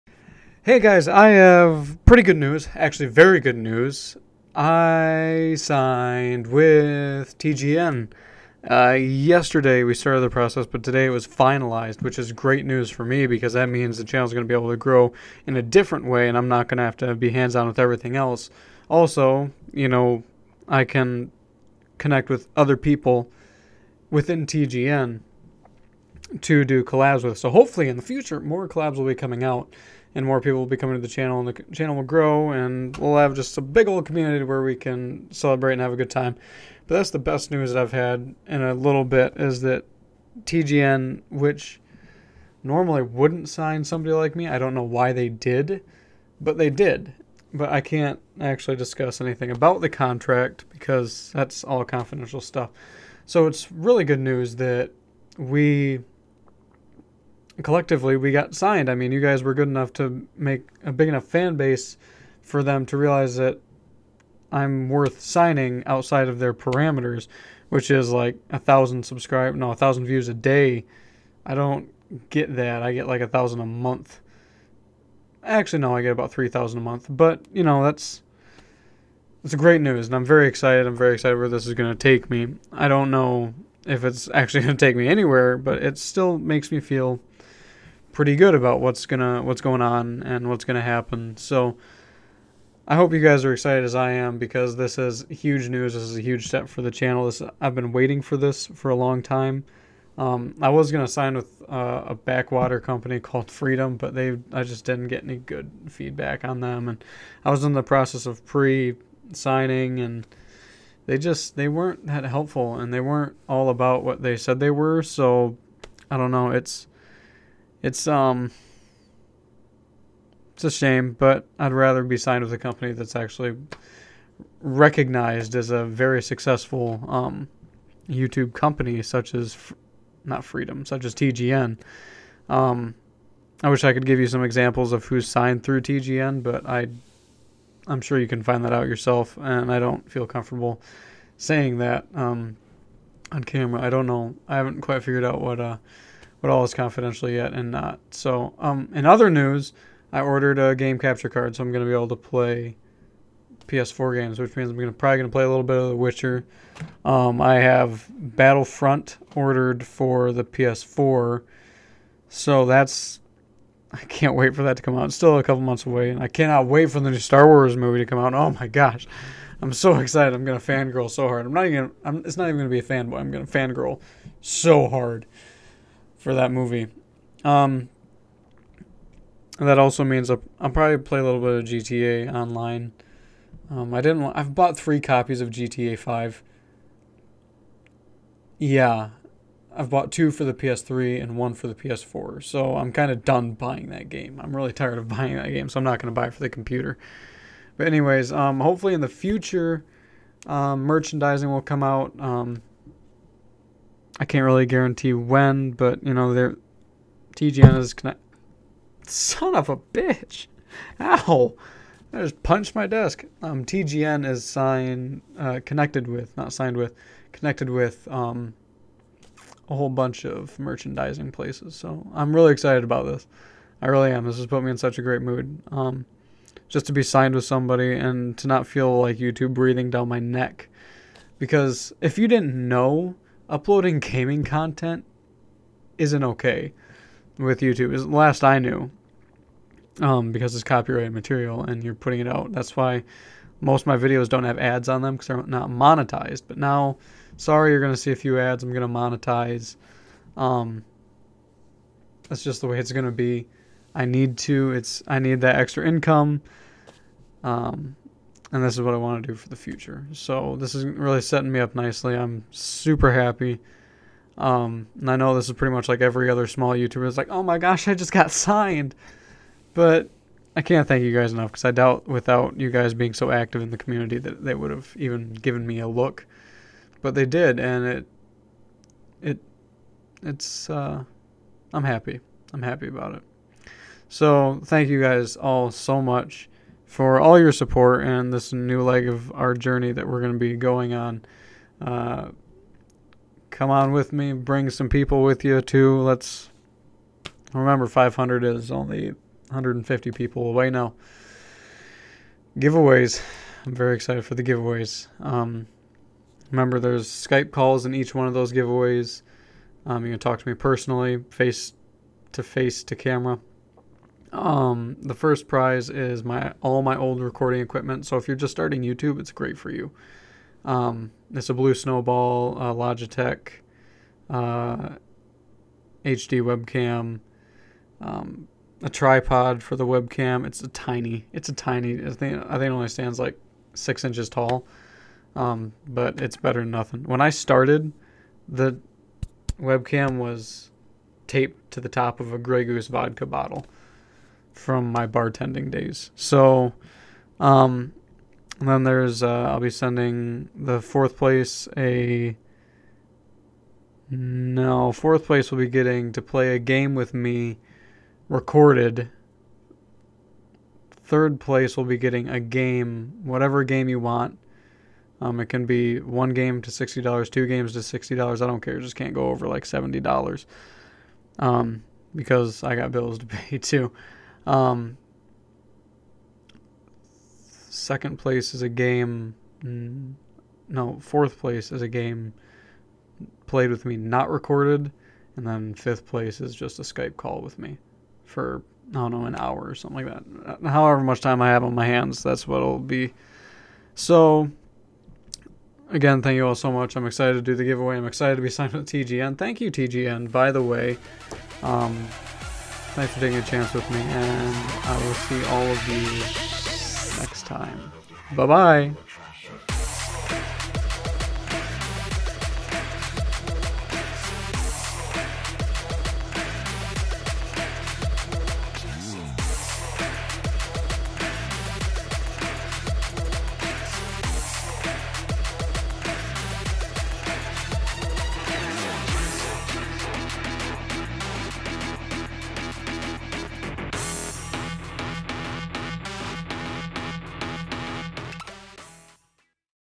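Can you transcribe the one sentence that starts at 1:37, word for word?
This I've been waiting for this for a long time.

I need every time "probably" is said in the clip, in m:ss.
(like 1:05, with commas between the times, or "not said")
2:34, 3:00.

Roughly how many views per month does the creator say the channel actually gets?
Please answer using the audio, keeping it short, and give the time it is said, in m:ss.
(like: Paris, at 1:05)
3000, at 1:16.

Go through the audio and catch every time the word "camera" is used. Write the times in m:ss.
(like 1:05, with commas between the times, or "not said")
2:23, 5:12.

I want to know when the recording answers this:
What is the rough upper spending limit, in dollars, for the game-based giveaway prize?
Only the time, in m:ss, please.
6:09.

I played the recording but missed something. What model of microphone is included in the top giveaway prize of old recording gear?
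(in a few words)
Blue Snowball.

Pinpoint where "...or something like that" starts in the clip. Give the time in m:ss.
6:29.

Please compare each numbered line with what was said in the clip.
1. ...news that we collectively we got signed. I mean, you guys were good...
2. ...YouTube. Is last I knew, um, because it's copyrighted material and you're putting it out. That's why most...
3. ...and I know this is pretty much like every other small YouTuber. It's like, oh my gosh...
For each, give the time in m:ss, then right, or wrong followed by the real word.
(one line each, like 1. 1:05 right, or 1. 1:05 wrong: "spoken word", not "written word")
1. 0:54 right
2. 3:57 right
3. 4:24 right.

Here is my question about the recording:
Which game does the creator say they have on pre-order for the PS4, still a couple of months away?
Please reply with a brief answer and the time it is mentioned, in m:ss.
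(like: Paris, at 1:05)
Battlefront, at 2:38.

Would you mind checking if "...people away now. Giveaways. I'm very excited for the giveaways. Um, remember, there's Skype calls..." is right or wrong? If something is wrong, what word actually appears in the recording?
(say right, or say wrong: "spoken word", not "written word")
right.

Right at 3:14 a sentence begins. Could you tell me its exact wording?
I'm really tired of buying that game, so I'm not going to buy it for the computer.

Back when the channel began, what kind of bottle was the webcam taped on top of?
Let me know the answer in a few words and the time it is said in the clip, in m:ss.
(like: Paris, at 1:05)
Grey Goose vodka bottle, at 5:42.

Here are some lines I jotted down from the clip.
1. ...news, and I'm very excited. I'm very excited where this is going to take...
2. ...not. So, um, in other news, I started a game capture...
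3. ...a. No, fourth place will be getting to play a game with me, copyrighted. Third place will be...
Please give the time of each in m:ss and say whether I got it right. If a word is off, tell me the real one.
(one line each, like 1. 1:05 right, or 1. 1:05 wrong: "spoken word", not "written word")
1. 1:19 right
2. 2:27 wrong: "ordered", not "started"
3. 5:51 wrong: "recorded", not "copyrighted".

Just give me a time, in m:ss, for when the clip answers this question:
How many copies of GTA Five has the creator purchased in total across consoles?
3:04.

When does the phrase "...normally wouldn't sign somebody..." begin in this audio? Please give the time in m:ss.
0:42.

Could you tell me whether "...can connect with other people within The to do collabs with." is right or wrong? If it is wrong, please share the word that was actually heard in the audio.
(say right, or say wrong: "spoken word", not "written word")
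wrong: "TGN", not "The".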